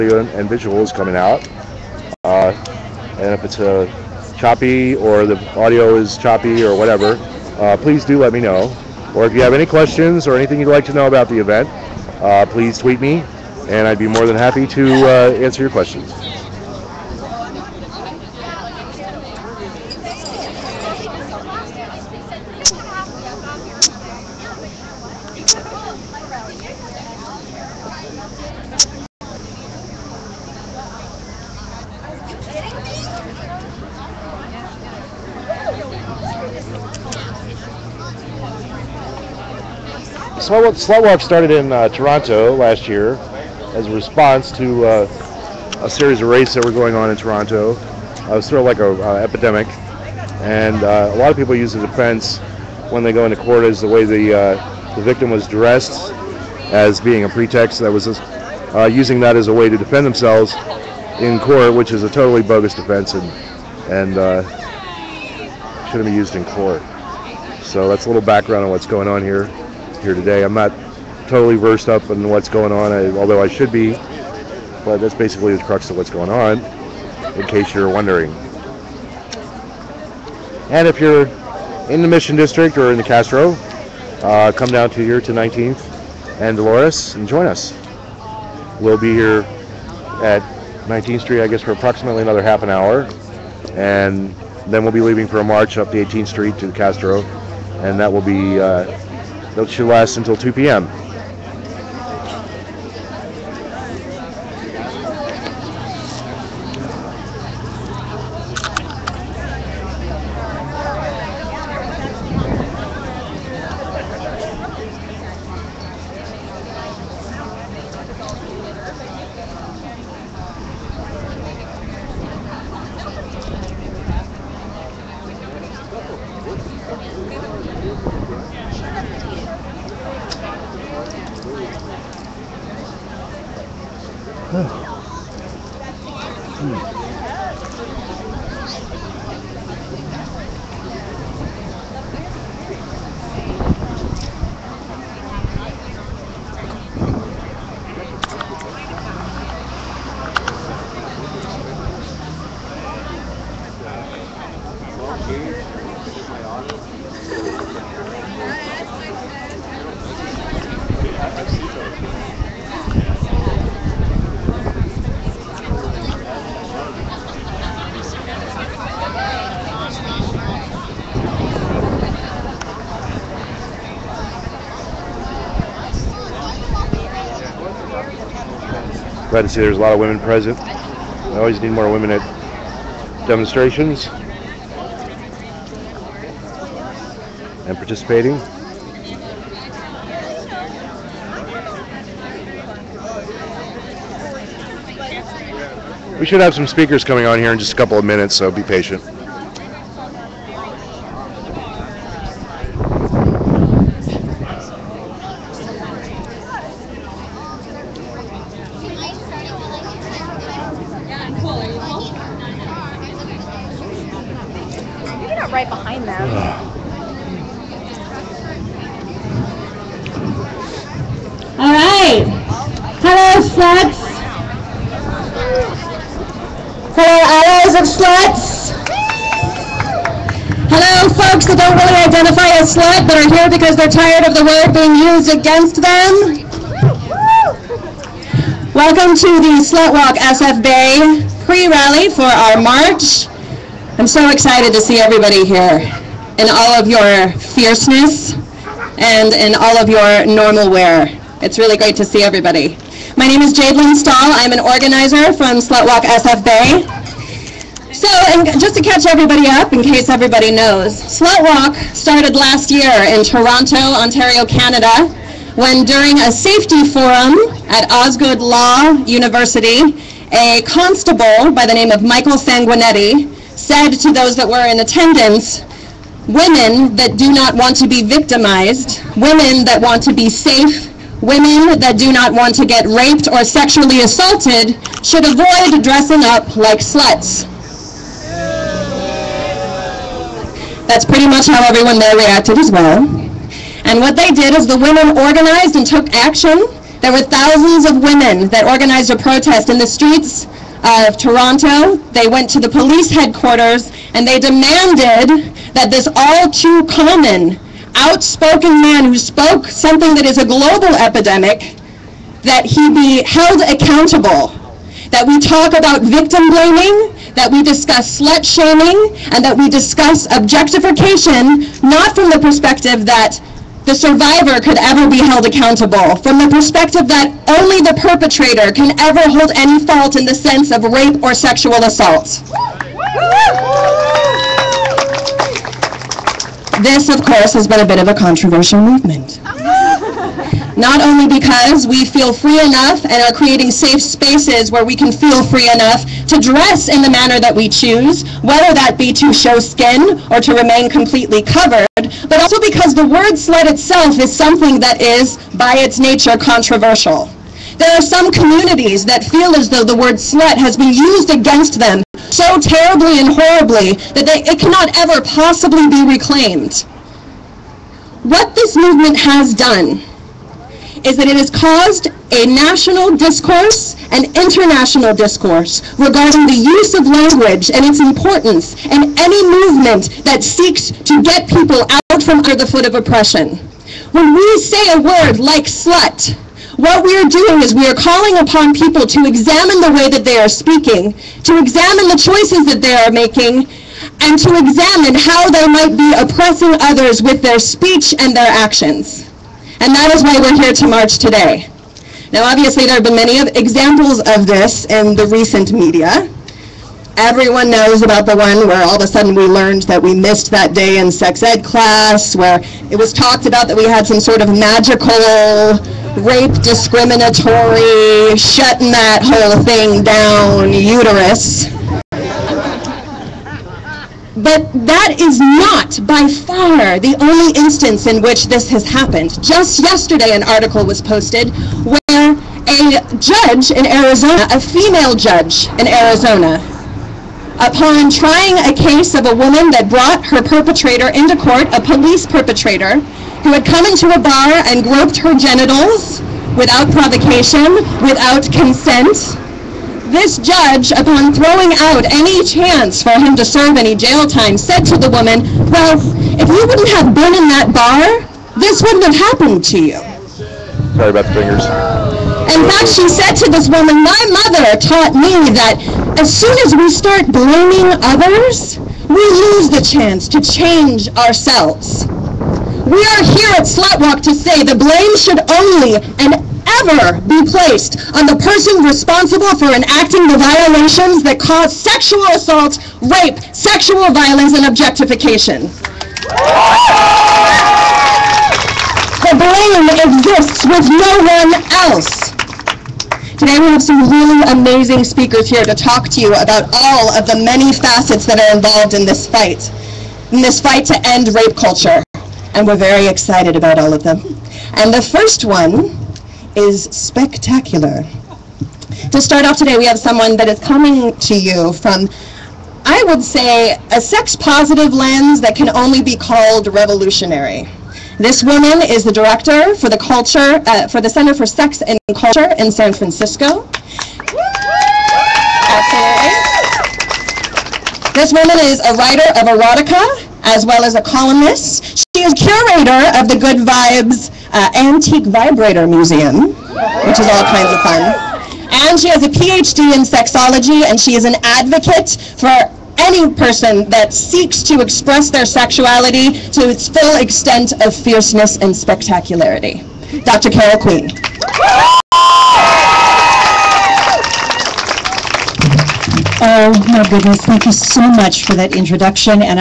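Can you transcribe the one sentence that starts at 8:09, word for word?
The blame exists with no one else.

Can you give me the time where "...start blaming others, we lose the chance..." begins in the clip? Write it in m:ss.
7:46.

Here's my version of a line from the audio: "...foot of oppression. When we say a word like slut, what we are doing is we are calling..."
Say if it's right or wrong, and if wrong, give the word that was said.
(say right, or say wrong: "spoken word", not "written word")
right.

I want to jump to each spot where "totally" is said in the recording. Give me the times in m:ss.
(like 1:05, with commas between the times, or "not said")
1:02, 1:11.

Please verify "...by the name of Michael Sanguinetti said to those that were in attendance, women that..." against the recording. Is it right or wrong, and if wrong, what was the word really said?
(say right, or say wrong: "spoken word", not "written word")
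right.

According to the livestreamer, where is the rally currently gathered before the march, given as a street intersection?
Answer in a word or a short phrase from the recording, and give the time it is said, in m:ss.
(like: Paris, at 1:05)
19th and Dolores, at 1:25.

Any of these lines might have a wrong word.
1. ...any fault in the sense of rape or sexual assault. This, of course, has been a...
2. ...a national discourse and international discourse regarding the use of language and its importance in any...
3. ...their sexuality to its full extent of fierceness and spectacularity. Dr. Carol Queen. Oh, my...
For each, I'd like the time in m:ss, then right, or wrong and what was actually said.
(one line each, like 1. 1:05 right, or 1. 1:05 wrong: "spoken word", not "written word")
1. 5:29 right
2. 6:12 right
3. 9:05 right.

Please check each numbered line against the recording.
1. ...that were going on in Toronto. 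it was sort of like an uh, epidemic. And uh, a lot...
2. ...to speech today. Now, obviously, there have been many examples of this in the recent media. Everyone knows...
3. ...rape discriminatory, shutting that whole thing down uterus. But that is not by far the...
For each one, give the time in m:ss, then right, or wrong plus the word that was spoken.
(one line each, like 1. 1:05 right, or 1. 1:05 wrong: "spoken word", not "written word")
1. 0:46 right
2. 6:40 wrong: "march", not "speech"
3. 6:56 right.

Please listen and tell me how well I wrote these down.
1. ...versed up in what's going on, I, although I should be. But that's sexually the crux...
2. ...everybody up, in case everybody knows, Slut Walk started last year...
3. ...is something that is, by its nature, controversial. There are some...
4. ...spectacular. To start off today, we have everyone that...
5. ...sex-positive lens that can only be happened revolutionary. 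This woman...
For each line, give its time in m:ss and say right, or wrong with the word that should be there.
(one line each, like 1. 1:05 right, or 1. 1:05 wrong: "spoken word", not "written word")
1. 1:11 wrong: "basically", not "sexually"
2. 4:19 right
3. 5:54 right
4. 8:26 wrong: "someone", not "everyone"
5. 8:33 wrong: "called", not "happened".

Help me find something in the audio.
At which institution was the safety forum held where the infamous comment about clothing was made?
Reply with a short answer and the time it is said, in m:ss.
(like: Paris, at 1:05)
Osgoode Law University, at 4:27.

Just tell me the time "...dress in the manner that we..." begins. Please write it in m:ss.
5:46.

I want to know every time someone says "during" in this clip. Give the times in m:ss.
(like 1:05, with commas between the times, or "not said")
4:25.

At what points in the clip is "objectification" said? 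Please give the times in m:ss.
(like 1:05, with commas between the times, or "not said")
5:20, 8:04.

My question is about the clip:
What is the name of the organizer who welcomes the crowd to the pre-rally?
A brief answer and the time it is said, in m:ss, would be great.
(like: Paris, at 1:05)
Jade Lynn Stahl, at 4:13.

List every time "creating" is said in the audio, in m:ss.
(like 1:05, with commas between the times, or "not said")
5:43.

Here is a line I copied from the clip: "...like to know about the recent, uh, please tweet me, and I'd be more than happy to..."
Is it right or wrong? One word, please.
wrong.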